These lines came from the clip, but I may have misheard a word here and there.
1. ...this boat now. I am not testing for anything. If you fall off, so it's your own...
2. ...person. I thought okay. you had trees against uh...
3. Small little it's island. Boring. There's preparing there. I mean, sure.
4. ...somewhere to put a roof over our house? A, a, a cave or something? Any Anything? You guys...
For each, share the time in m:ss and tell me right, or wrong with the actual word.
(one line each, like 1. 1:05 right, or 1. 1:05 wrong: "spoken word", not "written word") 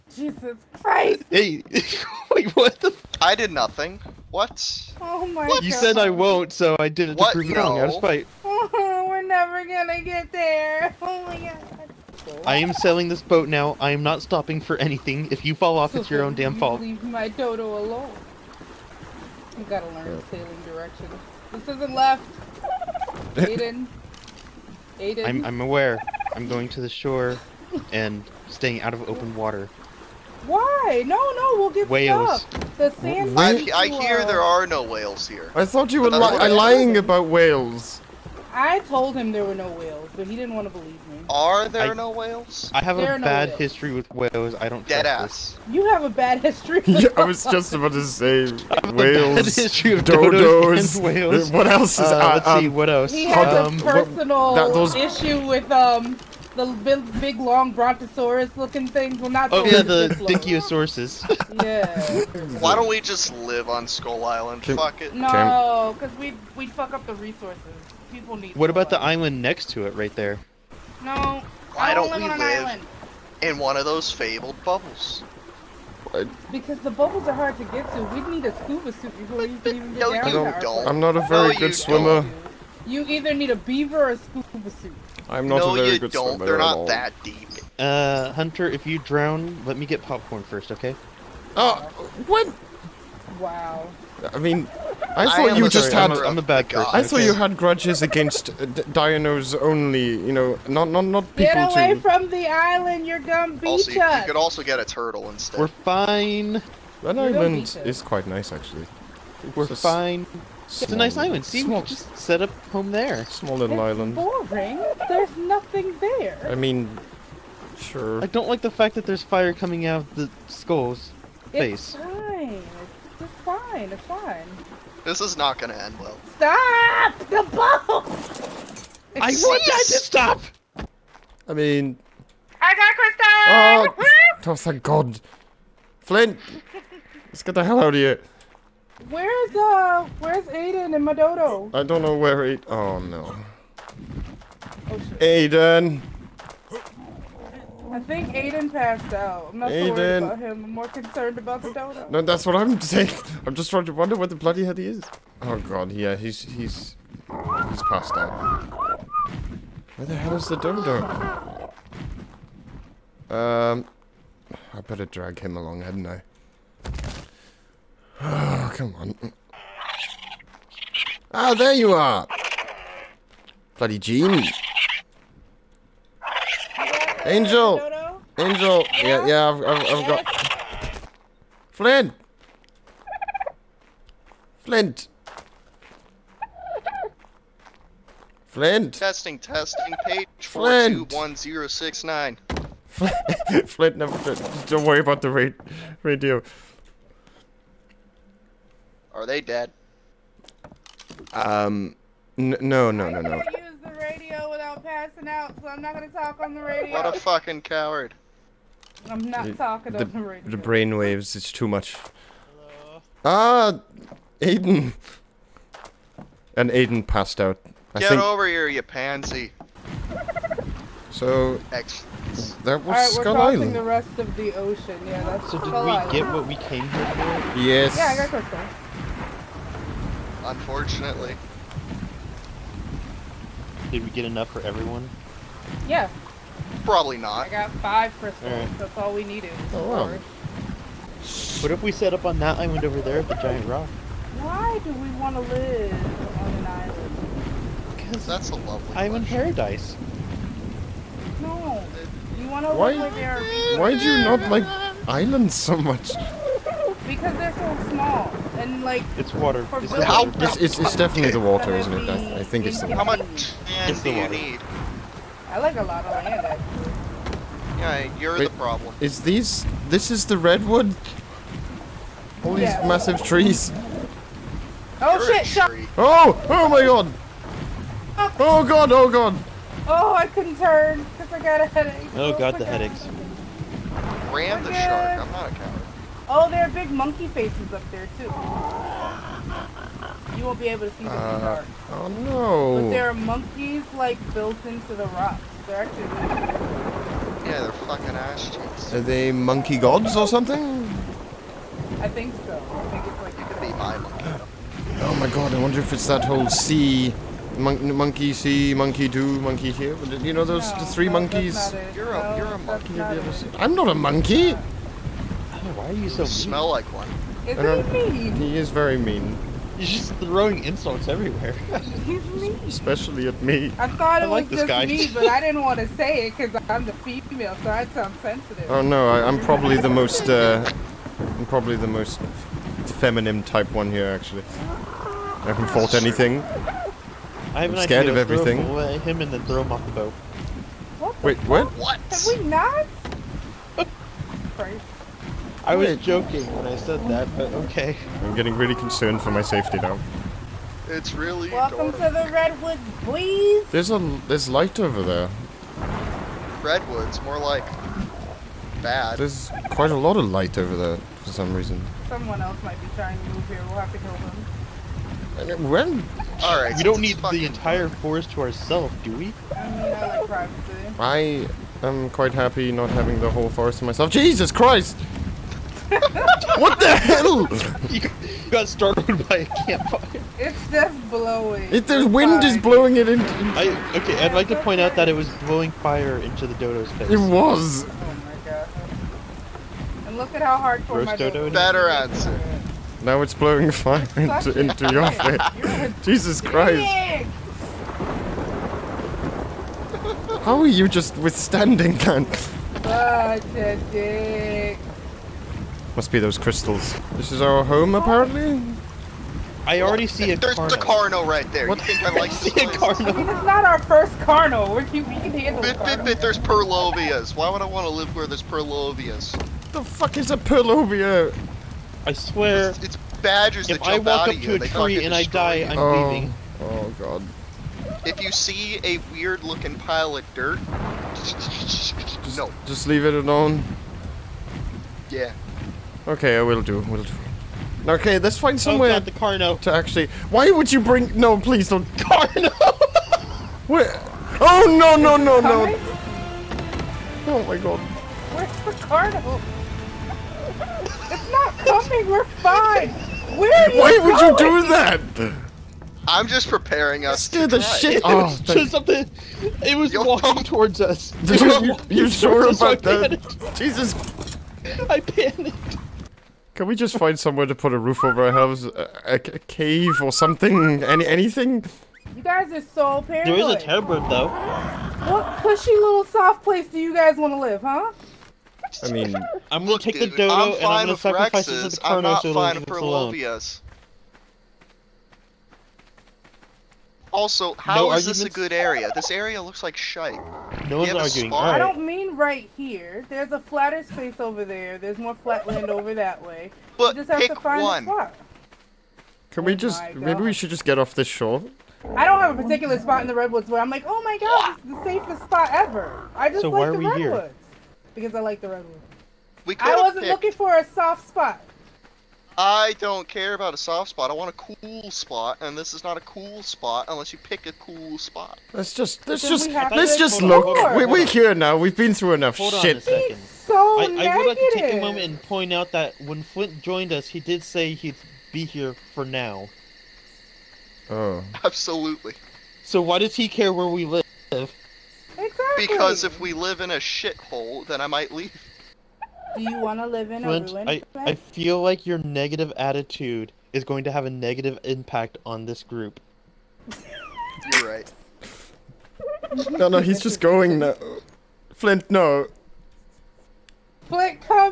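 1. 0:13 wrong: "stopping", not "testing"
2. 1:36 wrong: "grudges", not "trees"
3. 1:53 wrong: "nothing", not "preparing"
4. 7:47 right.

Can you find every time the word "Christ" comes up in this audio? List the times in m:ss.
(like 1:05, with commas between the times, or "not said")
0:00, 5:44, 6:14, 6:36.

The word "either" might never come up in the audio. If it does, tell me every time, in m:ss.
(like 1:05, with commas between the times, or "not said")
1:23.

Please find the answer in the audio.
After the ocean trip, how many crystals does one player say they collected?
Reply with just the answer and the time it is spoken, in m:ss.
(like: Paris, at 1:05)
5, at 3:57.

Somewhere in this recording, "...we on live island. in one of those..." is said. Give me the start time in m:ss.
1:12.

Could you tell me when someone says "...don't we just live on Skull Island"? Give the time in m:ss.
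1:02.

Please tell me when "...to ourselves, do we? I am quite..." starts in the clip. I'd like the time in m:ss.
6:08.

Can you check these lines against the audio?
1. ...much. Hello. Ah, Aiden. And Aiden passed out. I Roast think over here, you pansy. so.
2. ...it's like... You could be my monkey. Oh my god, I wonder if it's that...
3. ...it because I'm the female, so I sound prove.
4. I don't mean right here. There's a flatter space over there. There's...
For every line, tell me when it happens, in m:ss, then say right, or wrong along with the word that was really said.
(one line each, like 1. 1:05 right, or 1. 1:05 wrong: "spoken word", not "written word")
1. 3:31 wrong: "Get", not "Roast"
2. 5:03 right
3. 5:26 wrong: "sensitive", not "prove"
4. 8:11 right.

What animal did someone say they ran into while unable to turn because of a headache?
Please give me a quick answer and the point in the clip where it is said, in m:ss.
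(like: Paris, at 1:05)
shark, at 4:44.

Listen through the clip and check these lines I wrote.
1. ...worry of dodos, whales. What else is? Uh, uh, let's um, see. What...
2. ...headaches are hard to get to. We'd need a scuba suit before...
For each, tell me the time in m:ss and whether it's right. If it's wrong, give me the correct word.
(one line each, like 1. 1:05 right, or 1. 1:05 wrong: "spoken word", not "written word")
1. 0:49 wrong: "history", not "worry"
2. 1:16 wrong: "bubbles", not "headaches".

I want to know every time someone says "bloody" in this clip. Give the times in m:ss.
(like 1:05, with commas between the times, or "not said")
2:34, 2:53.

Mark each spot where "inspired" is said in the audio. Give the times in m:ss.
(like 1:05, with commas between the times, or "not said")
not said.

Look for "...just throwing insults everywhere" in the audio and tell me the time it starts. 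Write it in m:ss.
5:19.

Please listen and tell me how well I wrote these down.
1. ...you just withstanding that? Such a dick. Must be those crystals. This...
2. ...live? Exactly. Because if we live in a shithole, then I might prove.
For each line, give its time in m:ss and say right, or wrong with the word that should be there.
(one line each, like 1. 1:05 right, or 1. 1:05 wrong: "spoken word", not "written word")
1. 6:40 right
2. 8:53 wrong: "leave", not "prove".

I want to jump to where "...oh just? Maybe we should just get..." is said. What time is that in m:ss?
8:19.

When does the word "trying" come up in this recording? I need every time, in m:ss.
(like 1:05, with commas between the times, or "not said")
2:33, 6:02.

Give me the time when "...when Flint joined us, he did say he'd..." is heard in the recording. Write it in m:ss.
8:46.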